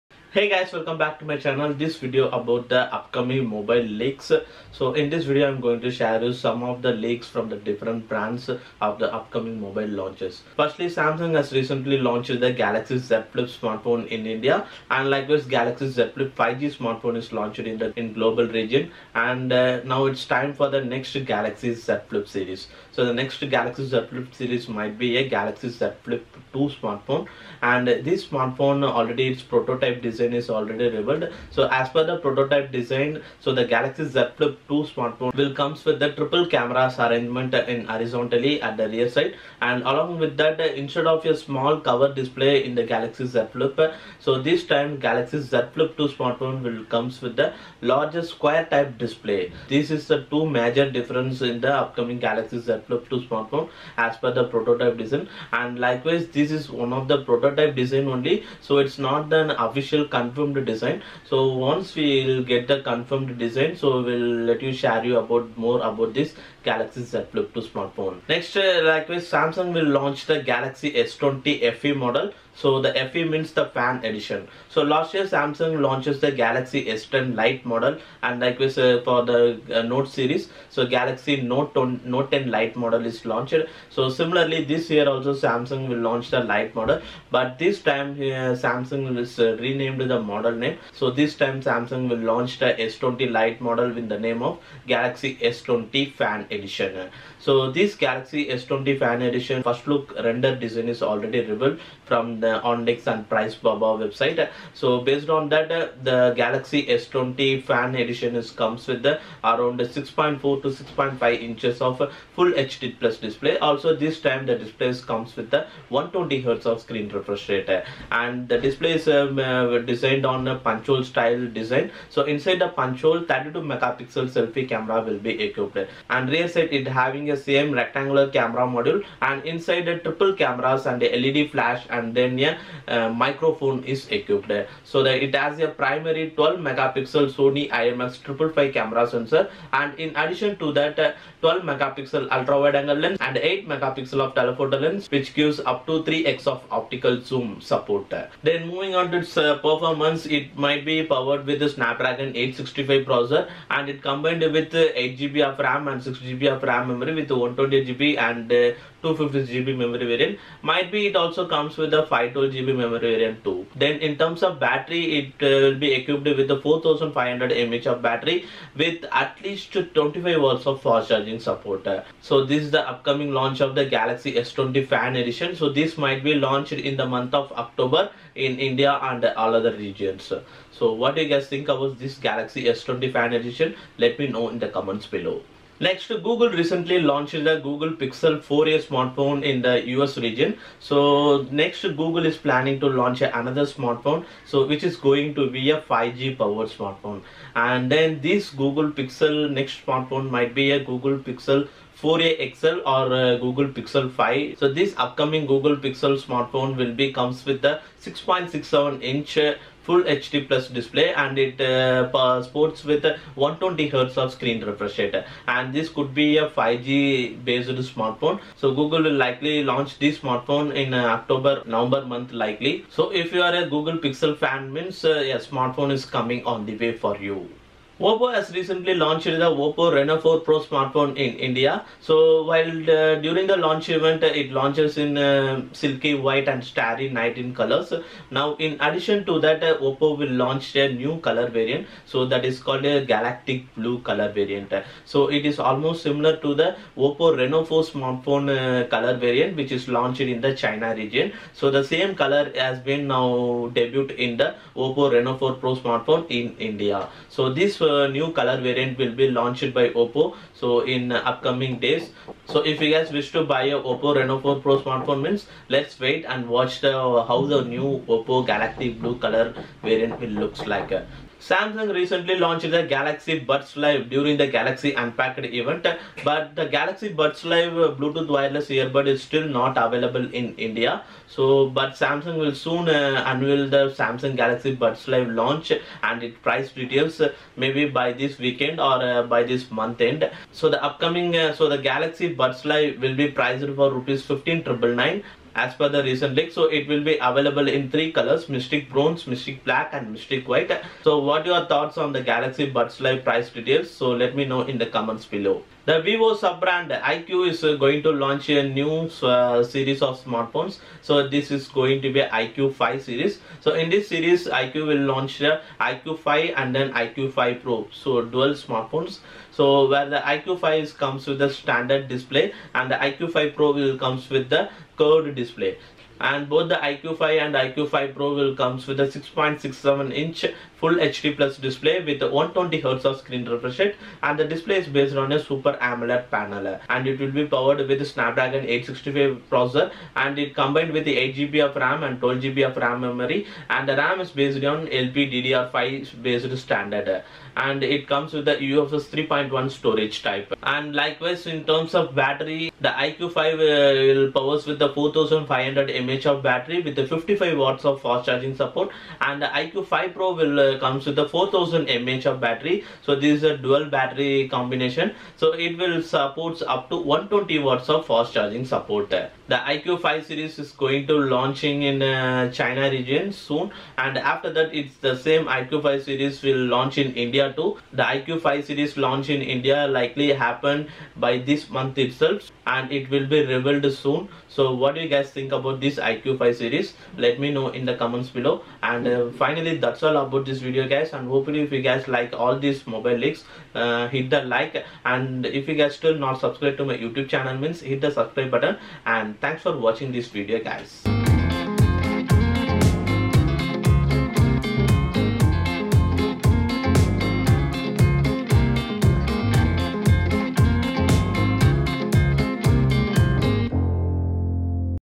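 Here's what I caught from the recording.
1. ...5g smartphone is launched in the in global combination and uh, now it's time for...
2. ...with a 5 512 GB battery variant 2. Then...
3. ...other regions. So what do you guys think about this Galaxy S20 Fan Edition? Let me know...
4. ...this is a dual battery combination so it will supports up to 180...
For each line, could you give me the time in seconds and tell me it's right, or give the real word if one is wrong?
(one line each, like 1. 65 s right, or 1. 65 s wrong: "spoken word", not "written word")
1. 16 s wrong: "region", not "combination"
2. 161 s wrong: "memory", not "battery"
3. 179 s right
4. 363 s wrong: "120", not "180".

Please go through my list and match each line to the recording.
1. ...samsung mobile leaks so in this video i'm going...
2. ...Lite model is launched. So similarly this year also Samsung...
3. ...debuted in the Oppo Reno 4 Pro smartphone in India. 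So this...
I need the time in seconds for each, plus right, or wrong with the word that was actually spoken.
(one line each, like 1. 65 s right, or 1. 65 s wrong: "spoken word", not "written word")
1. 2 s wrong: "upcoming", not "samsung"
2. 82 s right
3. 253 s right.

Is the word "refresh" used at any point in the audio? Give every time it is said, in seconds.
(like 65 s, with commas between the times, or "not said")
117 s, 214 s, 333 s.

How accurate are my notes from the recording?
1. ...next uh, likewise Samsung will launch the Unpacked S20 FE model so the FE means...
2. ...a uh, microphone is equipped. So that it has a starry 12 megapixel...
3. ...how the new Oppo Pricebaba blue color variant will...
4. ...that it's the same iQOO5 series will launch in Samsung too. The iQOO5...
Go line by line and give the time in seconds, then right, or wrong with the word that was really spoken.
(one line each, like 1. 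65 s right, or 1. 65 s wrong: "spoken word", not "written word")
1. 68 s wrong: "Galaxy", not "Unpacked"
2. 132 s wrong: "primary", not "starry"
3. 267 s wrong: "Galaxy", not "Pricebaba"
4. 374 s wrong: "India", not "Samsung".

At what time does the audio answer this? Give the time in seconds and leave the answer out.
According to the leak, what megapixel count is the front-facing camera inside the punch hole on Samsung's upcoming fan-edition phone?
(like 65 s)
123 s.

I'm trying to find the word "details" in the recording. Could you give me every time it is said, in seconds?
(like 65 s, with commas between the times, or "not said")
286 s, 303 s.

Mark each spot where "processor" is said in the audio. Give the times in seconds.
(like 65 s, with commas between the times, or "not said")
153 s, 339 s.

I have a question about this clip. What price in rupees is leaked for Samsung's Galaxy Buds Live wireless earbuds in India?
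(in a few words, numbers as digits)
Rs 15,999.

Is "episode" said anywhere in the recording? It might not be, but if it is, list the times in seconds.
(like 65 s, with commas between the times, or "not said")
not said.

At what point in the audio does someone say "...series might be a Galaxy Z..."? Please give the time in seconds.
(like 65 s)
24 s.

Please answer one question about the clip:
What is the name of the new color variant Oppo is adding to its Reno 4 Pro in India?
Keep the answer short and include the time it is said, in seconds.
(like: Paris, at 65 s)
Galactic blue, at 243 s.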